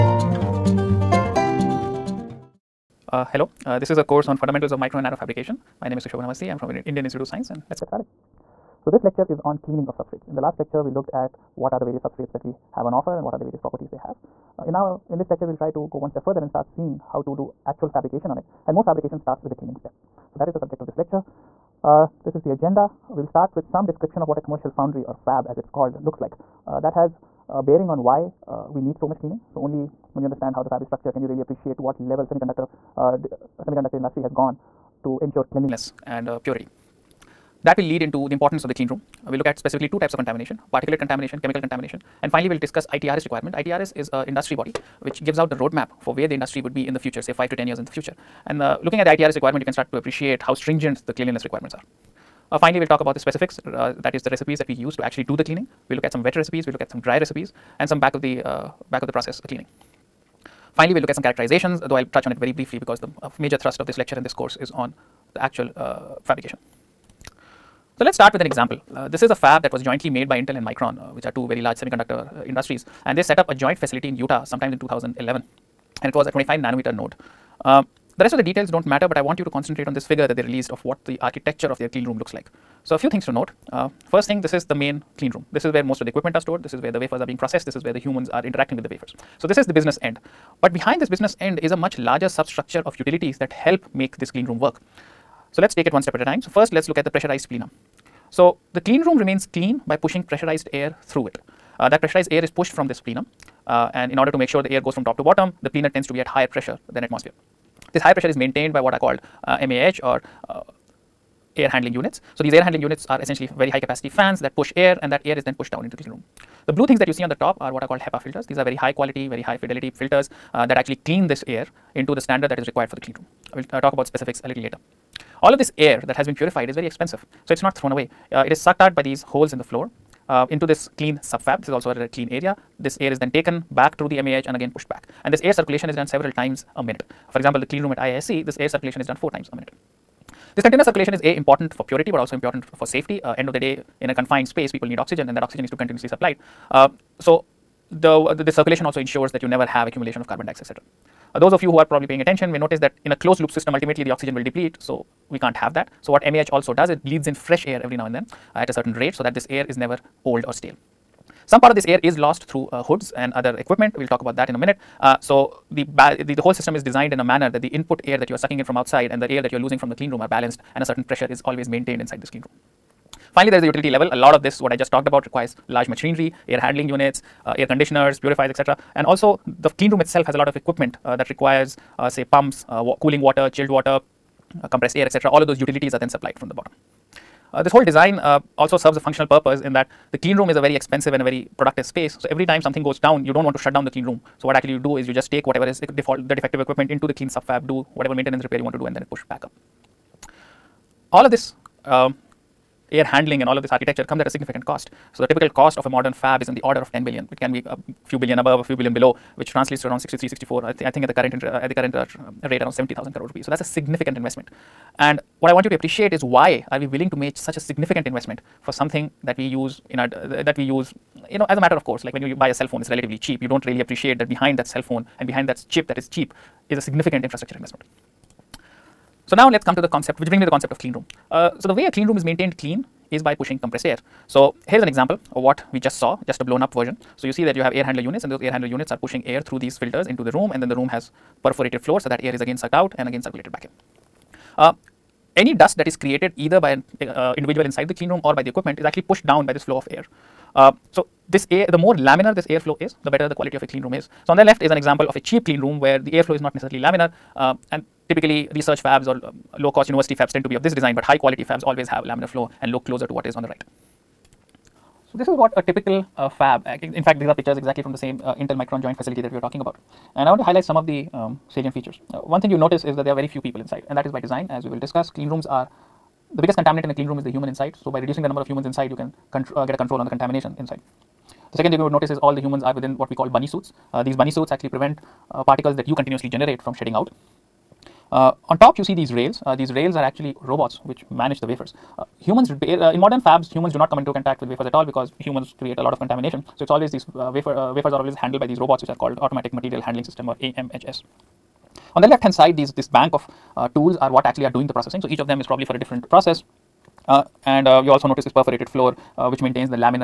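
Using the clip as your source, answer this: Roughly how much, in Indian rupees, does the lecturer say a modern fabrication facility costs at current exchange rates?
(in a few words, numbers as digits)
70,000 crore rupees.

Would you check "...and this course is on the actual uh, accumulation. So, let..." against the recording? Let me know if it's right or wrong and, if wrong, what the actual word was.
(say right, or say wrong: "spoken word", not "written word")
wrong: "fabrication", not "accumulation".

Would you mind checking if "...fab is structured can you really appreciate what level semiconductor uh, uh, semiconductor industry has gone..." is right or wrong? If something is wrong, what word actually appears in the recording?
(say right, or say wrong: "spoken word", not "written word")
right.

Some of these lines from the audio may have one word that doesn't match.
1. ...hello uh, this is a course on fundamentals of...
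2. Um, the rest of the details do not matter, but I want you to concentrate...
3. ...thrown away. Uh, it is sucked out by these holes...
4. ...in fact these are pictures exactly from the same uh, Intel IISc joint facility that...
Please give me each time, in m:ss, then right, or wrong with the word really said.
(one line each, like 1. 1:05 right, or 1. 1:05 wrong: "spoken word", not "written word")
1. 0:03 right
2. 1:17 right
3. 2:07 right
4. 4:26 wrong: "Micron", not "IISc".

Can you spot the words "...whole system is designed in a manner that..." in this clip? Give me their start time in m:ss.
2:46.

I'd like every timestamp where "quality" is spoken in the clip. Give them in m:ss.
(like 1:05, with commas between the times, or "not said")
1:58, 4:13, 4:21.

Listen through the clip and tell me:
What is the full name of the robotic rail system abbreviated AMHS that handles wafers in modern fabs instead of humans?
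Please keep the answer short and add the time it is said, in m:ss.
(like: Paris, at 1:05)
automatic material handling system, at 4:59.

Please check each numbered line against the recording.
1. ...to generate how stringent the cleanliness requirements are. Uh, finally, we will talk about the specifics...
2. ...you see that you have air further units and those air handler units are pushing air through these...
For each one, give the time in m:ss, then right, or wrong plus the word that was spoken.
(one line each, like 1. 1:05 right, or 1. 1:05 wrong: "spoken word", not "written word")
1. 0:49 wrong: "appreciate", not "generate"
2. 3:57 wrong: "handler", not "further".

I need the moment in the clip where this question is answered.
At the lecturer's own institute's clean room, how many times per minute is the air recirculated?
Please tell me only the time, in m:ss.
2:19.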